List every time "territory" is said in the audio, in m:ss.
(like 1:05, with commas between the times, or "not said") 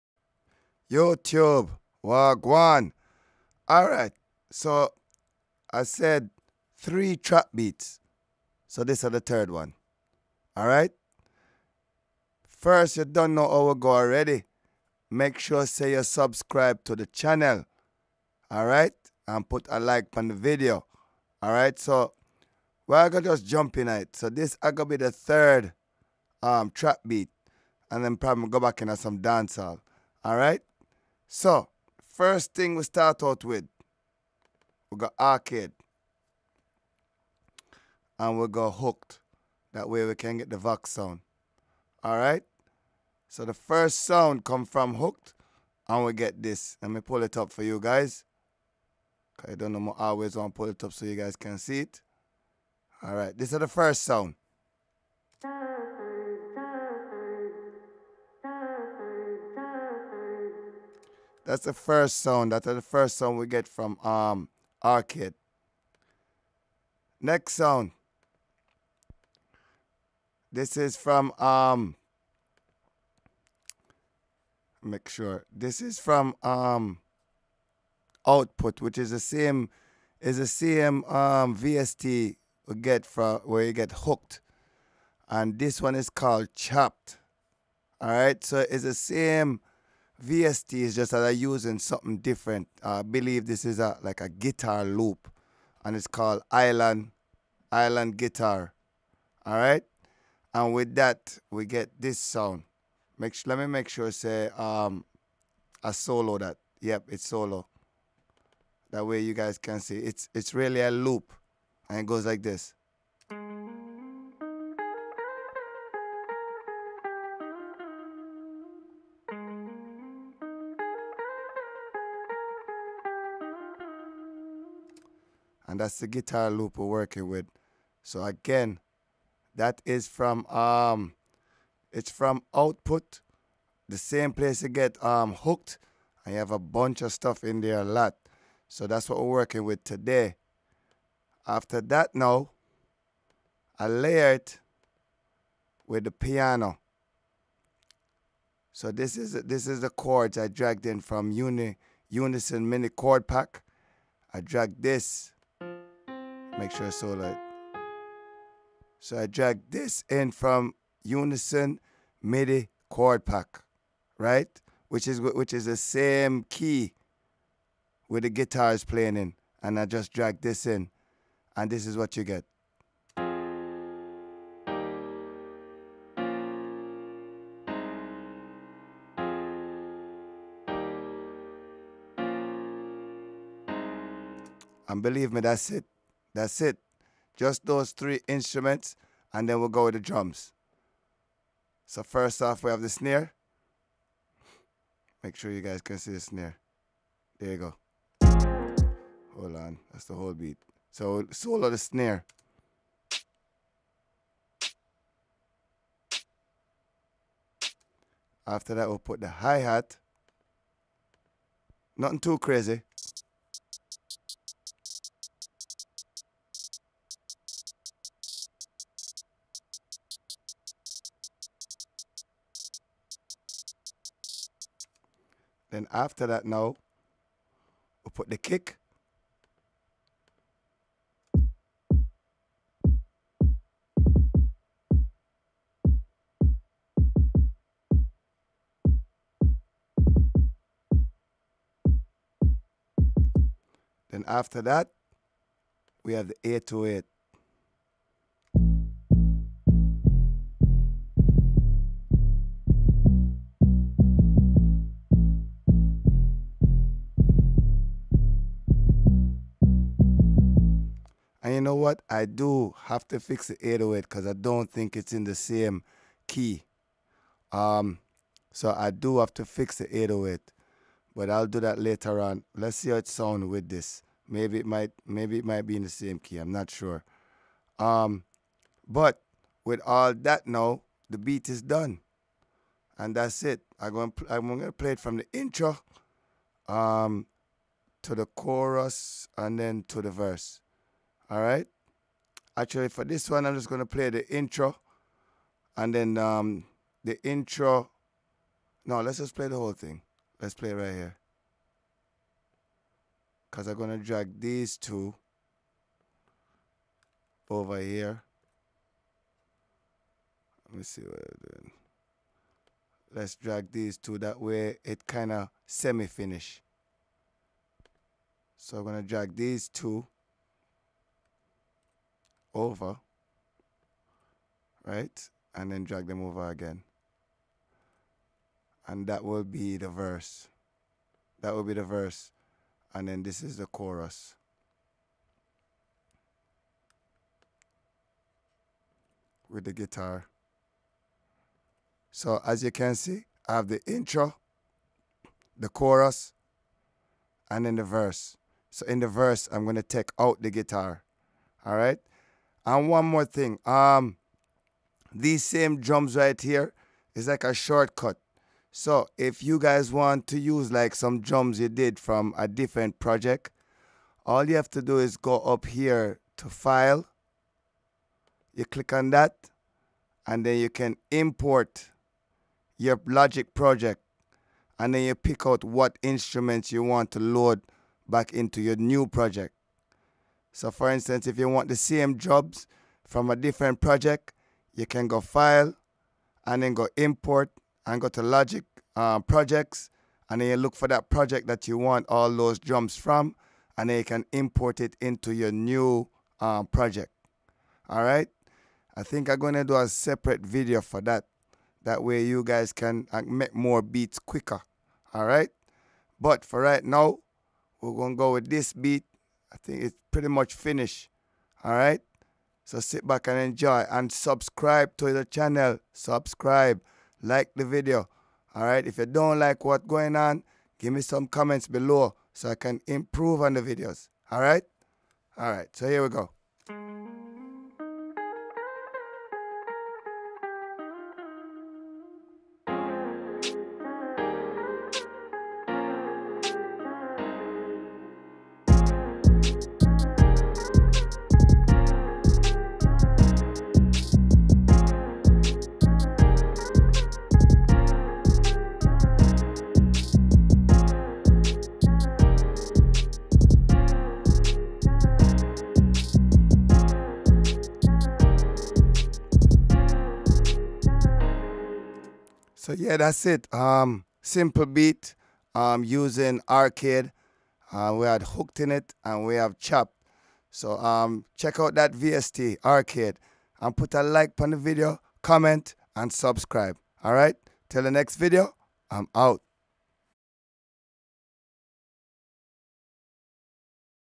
not said.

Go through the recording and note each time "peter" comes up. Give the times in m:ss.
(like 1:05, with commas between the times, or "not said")
not said.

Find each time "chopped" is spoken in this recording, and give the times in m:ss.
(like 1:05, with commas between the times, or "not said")
1:26, 7:49.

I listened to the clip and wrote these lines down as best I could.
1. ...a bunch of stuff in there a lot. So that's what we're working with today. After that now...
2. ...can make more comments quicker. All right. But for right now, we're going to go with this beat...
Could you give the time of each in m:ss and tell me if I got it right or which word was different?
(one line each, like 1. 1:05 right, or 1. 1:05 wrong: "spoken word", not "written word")
1. 2:16 right
2. 6:42 wrong: "beats", not "comments".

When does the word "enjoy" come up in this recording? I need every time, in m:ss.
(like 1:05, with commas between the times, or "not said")
6:53.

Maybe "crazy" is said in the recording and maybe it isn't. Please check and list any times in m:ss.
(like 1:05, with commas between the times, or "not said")
3:32.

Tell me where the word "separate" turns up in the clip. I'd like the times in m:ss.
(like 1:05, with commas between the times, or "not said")
6:39.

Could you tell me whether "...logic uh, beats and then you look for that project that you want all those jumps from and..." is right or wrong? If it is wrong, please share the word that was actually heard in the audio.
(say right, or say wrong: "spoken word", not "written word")
wrong: "projects", not "beats".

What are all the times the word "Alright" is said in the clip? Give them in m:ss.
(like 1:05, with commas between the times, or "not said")
0:42, 0:53, 1:28.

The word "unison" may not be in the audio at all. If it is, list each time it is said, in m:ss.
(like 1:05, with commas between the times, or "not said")
2:32, 2:41.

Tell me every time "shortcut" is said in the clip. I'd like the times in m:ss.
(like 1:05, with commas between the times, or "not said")
5:57.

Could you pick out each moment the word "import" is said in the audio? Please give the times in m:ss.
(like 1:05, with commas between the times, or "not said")
6:11, 6:26, 6:34.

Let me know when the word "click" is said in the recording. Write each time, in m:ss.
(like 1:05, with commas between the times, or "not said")
6:08.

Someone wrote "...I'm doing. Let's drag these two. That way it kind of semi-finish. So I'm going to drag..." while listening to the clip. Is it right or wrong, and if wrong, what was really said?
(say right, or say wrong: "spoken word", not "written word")
right.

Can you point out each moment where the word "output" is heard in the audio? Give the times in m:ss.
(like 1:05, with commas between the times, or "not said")
1:18, 2:12.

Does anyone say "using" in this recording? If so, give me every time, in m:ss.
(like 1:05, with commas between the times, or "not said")
1:31, 7:45.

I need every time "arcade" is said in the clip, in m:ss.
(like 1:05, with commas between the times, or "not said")
0:35, 1:04, 7:46, 7:52.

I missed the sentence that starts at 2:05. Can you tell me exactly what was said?
and that's the guitar loop we're working with.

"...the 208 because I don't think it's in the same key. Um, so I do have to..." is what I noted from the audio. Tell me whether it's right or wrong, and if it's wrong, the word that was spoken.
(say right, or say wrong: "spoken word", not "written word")
wrong: "808", not "208".